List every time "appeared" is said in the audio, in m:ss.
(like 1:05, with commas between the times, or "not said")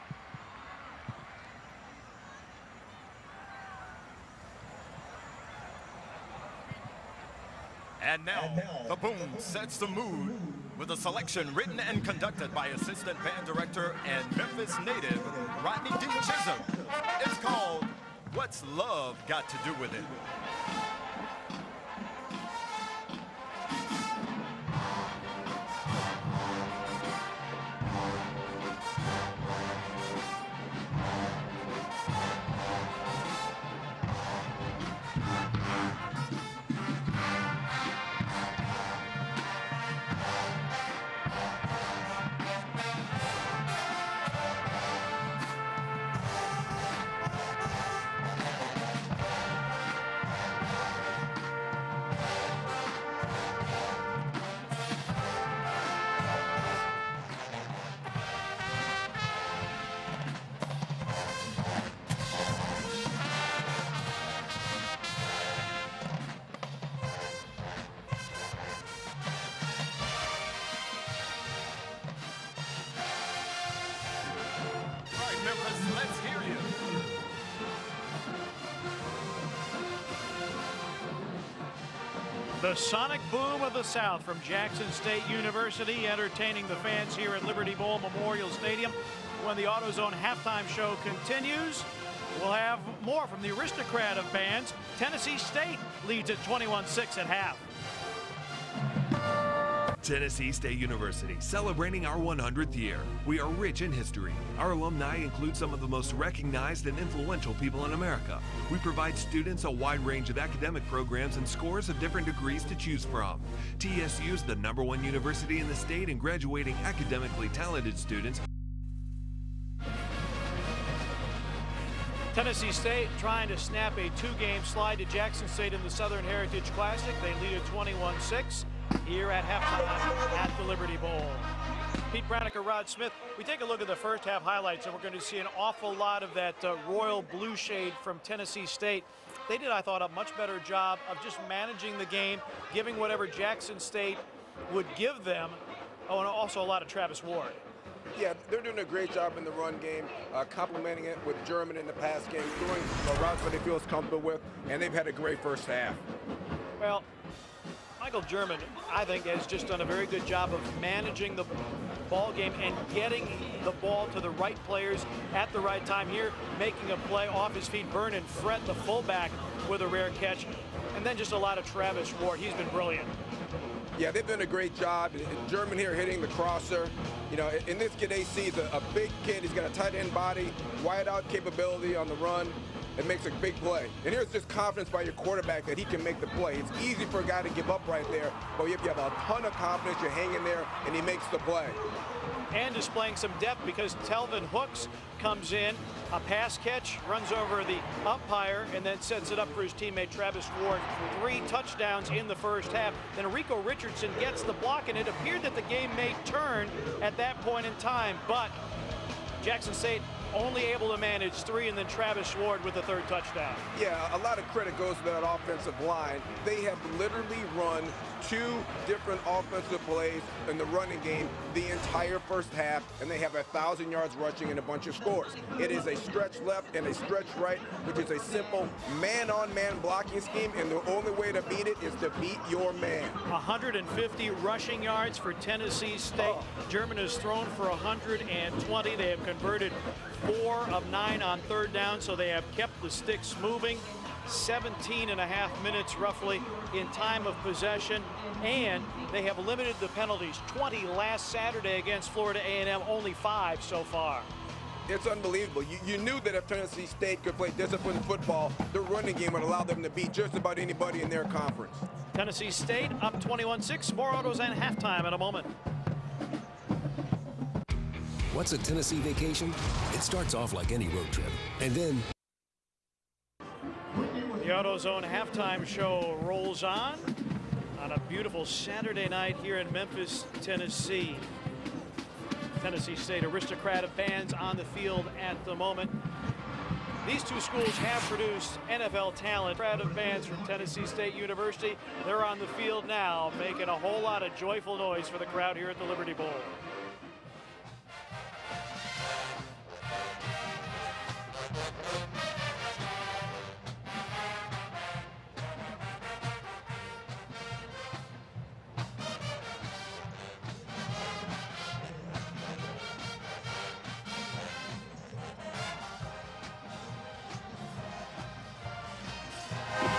3:25.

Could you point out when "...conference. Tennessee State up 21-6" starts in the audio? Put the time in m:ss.
4:21.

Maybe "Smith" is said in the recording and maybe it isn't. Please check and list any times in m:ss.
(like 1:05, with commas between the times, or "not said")
2:12, 2:33.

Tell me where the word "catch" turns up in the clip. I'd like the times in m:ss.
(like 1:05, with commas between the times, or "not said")
2:50, 3:16.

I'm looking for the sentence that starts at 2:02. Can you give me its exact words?
Tennessee State trying to snap a two-game slide to Jackson State in the Southern Heritage Classic.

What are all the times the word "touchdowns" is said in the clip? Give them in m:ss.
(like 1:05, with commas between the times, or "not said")
3:21, 3:33.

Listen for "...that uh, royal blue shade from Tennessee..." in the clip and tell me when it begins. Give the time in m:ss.
2:16.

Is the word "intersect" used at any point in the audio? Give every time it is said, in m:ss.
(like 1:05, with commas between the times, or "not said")
not said.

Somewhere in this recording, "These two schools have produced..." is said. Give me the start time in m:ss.
4:47.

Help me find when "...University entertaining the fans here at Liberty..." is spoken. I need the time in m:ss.
1:25.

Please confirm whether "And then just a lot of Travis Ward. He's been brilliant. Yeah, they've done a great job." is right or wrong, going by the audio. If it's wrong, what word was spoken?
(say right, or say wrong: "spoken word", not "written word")
right.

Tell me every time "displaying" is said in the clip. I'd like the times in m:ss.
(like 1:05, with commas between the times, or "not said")
3:12.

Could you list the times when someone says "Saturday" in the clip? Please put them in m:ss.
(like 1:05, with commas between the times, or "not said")
4:11, 4:38.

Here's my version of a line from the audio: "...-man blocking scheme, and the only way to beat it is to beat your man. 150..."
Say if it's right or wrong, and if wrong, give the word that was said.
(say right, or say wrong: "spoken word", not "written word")
right.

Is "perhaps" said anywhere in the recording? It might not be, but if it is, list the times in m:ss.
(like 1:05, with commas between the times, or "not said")
not said.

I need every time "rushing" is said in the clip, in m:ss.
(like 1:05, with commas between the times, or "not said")
3:44, 3:54.